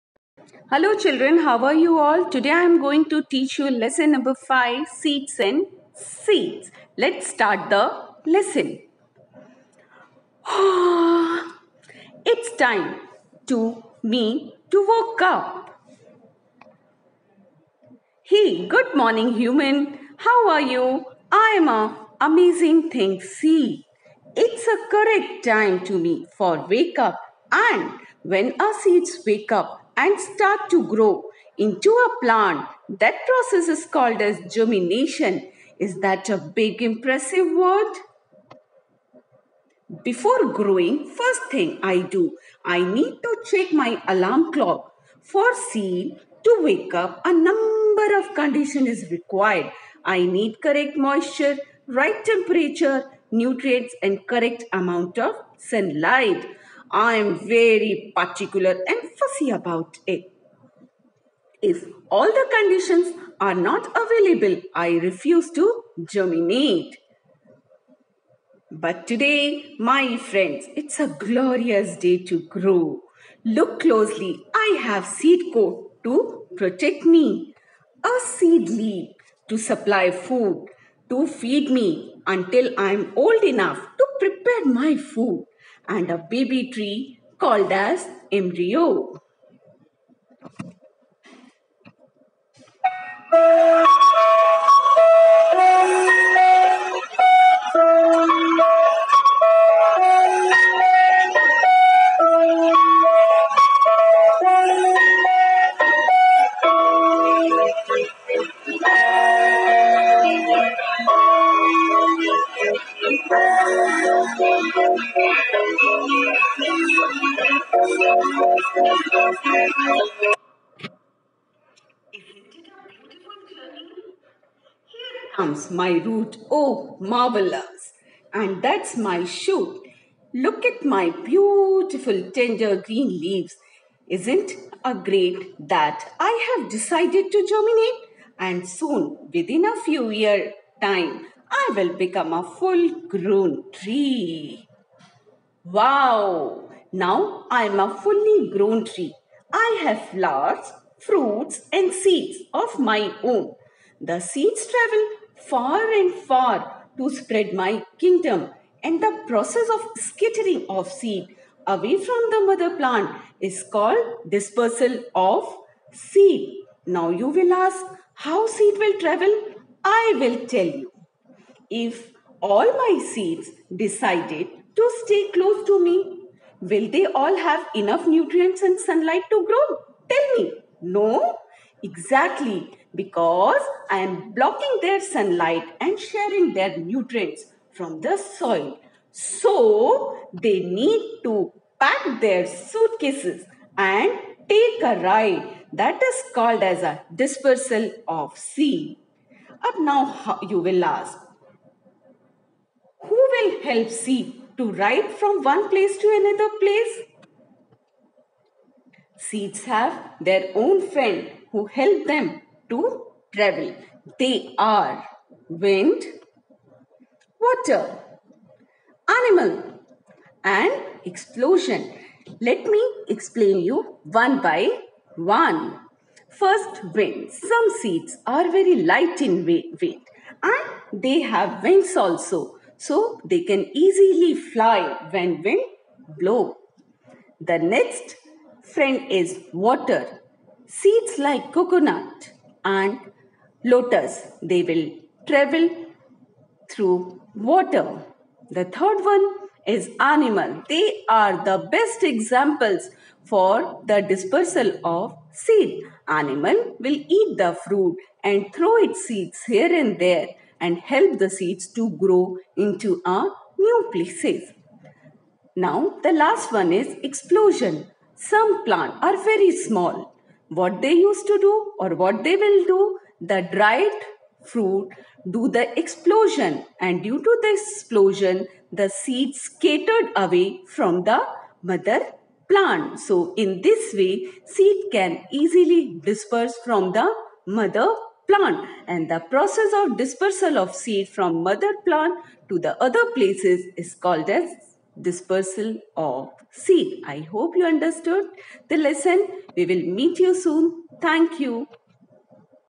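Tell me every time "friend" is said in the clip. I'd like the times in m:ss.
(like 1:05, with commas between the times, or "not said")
1:10, 3:30, 3:58.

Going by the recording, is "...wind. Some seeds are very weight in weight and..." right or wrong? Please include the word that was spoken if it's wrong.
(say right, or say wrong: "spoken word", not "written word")
wrong: "light", not "weight".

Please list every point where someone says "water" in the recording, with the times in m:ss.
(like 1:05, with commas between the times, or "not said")
3:37, 3:59, 4:07.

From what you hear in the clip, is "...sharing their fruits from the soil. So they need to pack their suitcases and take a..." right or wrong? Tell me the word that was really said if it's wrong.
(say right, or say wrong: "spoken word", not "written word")
wrong: "nutrients", not "fruits".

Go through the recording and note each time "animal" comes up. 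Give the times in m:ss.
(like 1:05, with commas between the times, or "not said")
3:39, 4:09, 4:16.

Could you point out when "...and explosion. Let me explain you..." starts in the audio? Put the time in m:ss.
3:40.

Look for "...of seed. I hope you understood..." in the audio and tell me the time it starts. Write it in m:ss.
4:55.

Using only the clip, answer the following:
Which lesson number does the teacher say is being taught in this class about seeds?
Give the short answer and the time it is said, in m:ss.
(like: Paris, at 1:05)
5, at 0:03.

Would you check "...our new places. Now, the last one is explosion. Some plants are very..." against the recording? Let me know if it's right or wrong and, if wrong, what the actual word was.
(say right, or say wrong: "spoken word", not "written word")
right.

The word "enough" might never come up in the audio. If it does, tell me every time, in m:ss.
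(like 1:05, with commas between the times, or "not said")
1:23, 2:57.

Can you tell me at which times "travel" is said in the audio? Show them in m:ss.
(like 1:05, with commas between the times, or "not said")
2:34, 2:49, 3:33, 4:05.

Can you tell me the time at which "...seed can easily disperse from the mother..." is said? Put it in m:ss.
4:44.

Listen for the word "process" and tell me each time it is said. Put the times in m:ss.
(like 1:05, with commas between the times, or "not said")
0:33, 2:39, 4:49.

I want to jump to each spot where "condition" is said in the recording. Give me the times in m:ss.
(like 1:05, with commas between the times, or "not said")
0:48, 1:02.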